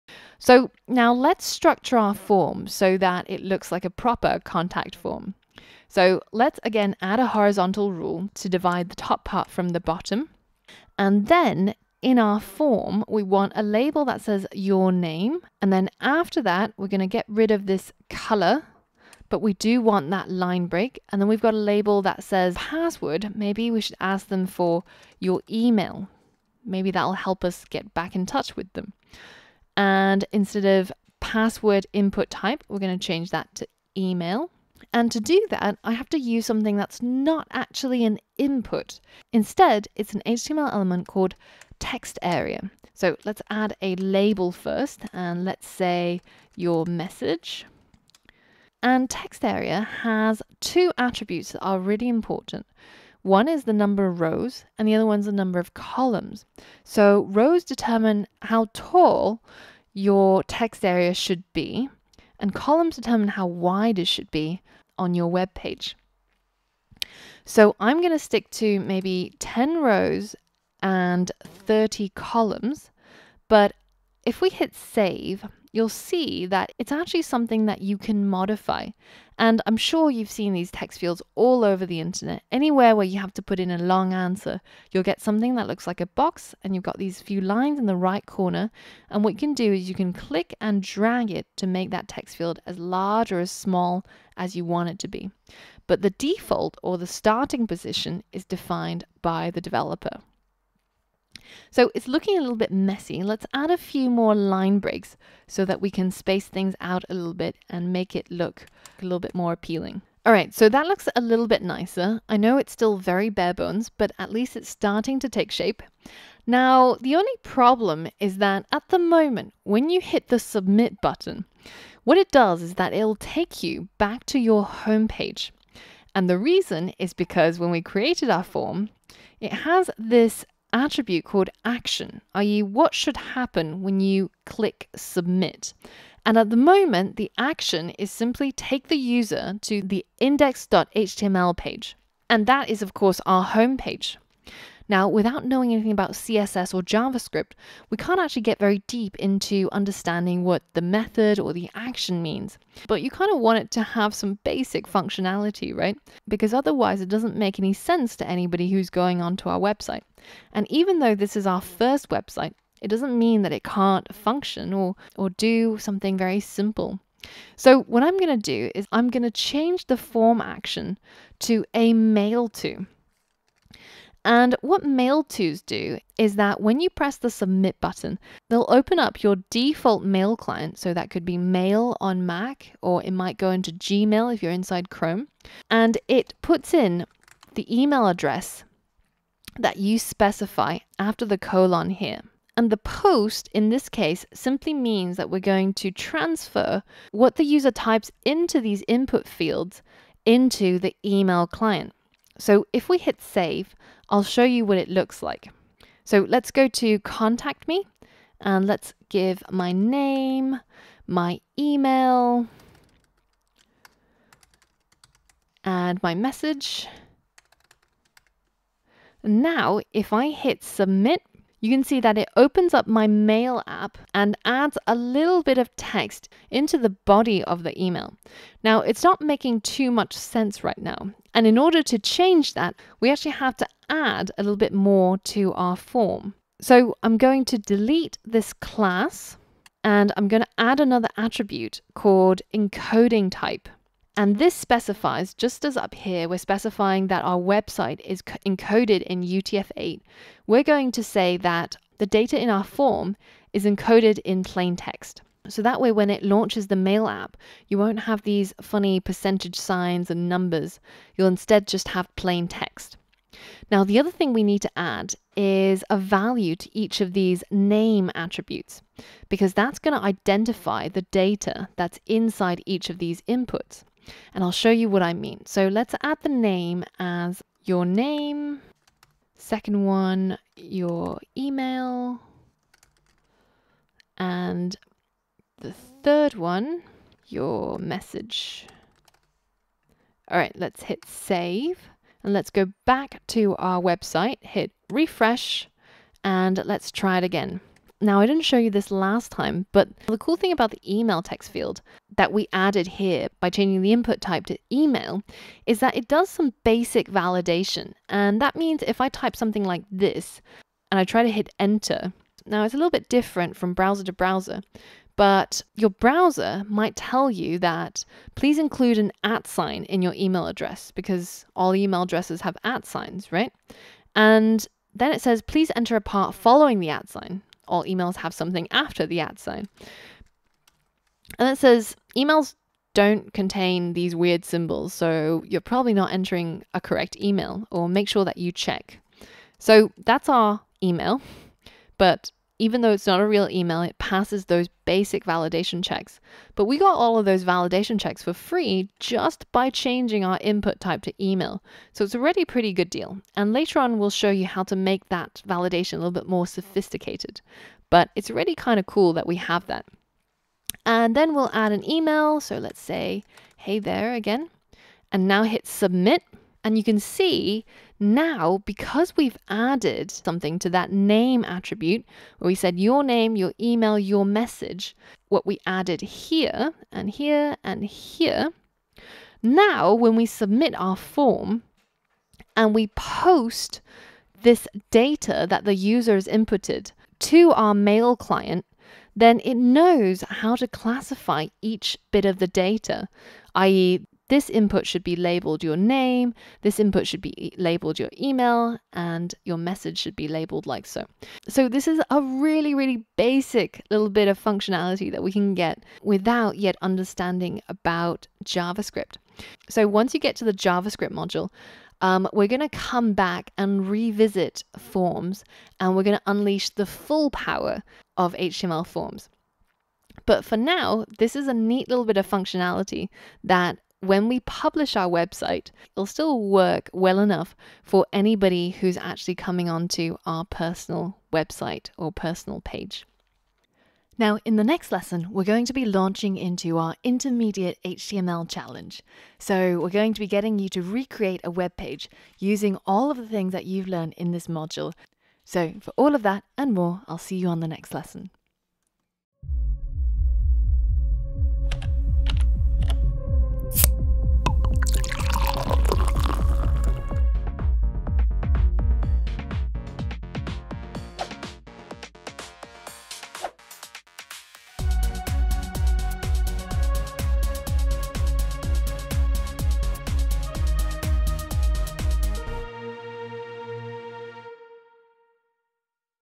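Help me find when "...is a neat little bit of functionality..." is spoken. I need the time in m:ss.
7:01.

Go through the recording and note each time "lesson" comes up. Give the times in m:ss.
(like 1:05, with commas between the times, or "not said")
7:14, 7:27.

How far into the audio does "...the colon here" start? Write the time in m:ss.
3:11.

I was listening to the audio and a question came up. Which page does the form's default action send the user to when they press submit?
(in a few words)
index.html.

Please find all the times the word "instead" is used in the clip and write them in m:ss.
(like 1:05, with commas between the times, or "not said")
0:30, 0:39, 4:21.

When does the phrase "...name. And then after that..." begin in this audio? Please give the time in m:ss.
0:14.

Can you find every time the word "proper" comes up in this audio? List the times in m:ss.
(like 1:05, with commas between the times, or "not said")
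0:03.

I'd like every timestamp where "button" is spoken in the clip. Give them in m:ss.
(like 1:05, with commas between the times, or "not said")
2:01, 2:57.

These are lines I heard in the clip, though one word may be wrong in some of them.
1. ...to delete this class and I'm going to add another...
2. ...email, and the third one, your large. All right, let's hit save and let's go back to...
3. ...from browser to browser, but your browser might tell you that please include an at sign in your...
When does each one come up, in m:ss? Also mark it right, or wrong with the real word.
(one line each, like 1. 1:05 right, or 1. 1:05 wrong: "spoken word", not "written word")
1. 3:57 right
2. 4:41 wrong: "message", not "large"
3. 5:13 right.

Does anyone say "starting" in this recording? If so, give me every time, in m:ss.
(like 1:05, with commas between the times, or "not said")
1:37, 1:54.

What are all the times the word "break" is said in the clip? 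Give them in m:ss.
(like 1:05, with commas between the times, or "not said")
0:20, 1:44.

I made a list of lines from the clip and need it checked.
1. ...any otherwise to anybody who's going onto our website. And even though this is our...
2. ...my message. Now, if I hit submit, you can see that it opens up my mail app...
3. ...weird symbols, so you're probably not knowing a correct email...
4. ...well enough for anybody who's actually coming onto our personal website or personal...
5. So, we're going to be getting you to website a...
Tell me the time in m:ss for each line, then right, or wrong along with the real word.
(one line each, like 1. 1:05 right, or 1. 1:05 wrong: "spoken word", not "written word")
1. 2:37 wrong: "sense", not "otherwise"
2. 3:36 right
3. 5:34 wrong: "entering", not "knowing"
4. 7:06 right
5. 7:19 wrong: "recreate", not "website".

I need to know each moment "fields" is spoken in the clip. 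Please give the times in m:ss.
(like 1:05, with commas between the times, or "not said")
1:20, 1:32, 3:19, 5:01.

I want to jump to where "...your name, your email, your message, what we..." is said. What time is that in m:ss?
6:12.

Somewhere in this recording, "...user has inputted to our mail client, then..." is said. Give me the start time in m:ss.
6:25.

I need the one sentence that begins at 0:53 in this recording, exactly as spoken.
One is the number of rows, and the other one's the number of columns.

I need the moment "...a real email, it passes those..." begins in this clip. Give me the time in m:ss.
5:43.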